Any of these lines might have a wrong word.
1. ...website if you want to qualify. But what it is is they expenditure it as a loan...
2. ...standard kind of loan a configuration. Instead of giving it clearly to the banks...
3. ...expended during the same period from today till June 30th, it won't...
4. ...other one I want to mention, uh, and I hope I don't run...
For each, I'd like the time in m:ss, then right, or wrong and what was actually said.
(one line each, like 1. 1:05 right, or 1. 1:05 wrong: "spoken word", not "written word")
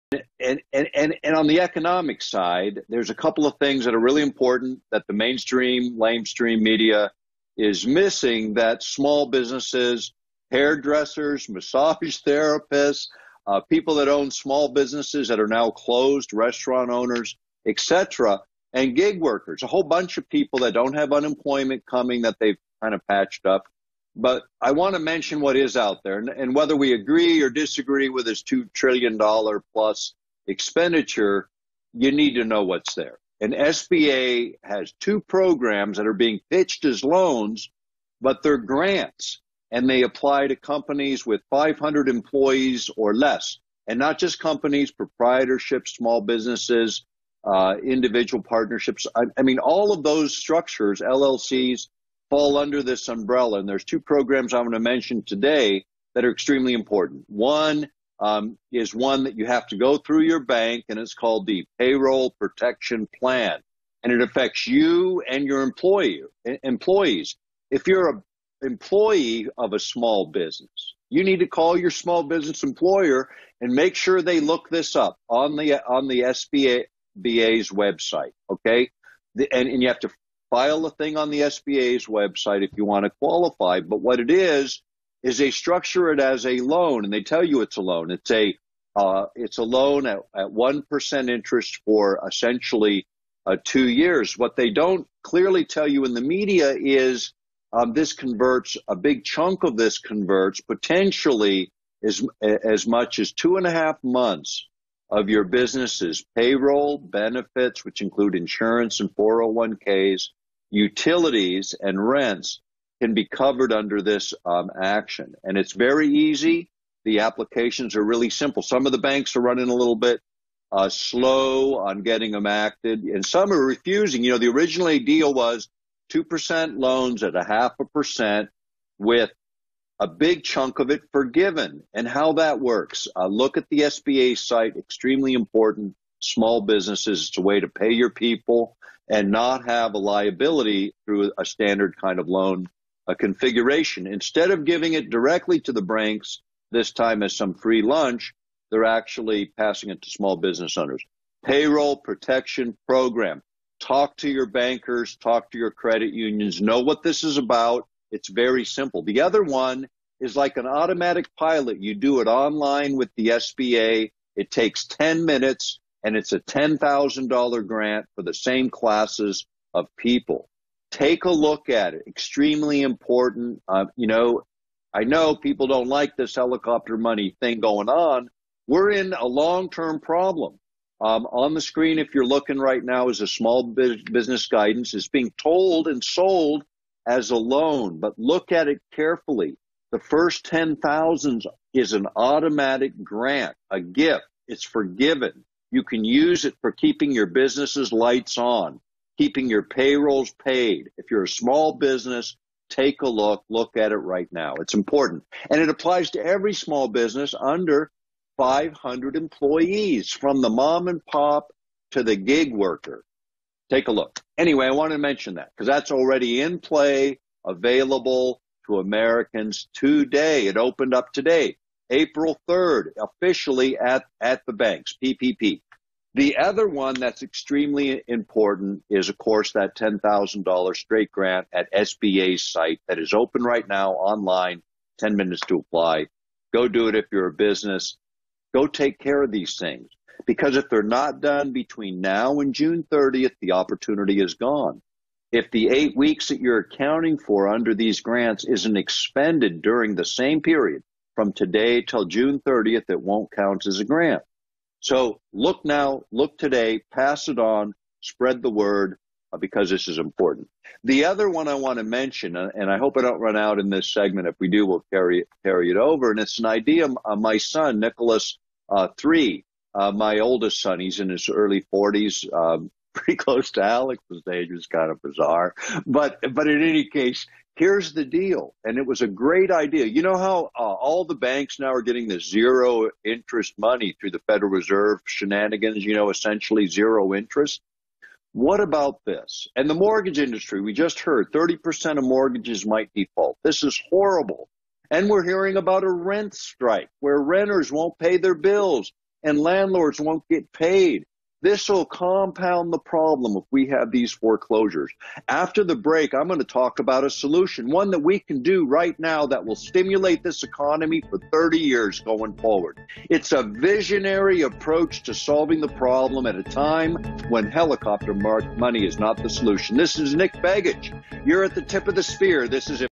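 1. 1:22 wrong: "structure", not "expenditure"
2. 2:21 wrong: "directly", not "clearly"
3. 4:08 right
4. 4:21 right.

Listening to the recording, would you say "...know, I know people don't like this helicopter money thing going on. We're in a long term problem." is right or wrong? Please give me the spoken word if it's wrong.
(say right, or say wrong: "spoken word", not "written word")
right.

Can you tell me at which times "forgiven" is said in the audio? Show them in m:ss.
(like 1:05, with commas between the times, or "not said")
2:11, 3:14.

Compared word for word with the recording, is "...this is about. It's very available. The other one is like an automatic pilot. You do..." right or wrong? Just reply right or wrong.
wrong.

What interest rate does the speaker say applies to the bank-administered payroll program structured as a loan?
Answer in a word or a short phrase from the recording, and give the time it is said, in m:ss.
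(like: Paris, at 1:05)
1%, at 1:30.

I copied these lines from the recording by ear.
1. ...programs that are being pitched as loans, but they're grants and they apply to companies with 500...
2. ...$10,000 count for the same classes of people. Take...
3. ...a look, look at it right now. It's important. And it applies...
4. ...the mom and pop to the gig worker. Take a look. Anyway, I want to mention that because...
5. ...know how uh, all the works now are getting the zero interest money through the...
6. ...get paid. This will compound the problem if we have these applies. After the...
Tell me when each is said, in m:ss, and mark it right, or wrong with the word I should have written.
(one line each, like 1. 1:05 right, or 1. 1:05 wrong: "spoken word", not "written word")
1. 0:35 right
2. 2:46 wrong: "grant", not "count"
3. 3:23 right
4. 3:30 right
5. 4:40 wrong: "banks", not "works"
6. 5:00 wrong: "foreclosures", not "applies".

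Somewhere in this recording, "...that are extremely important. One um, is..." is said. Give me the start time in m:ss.
0:56.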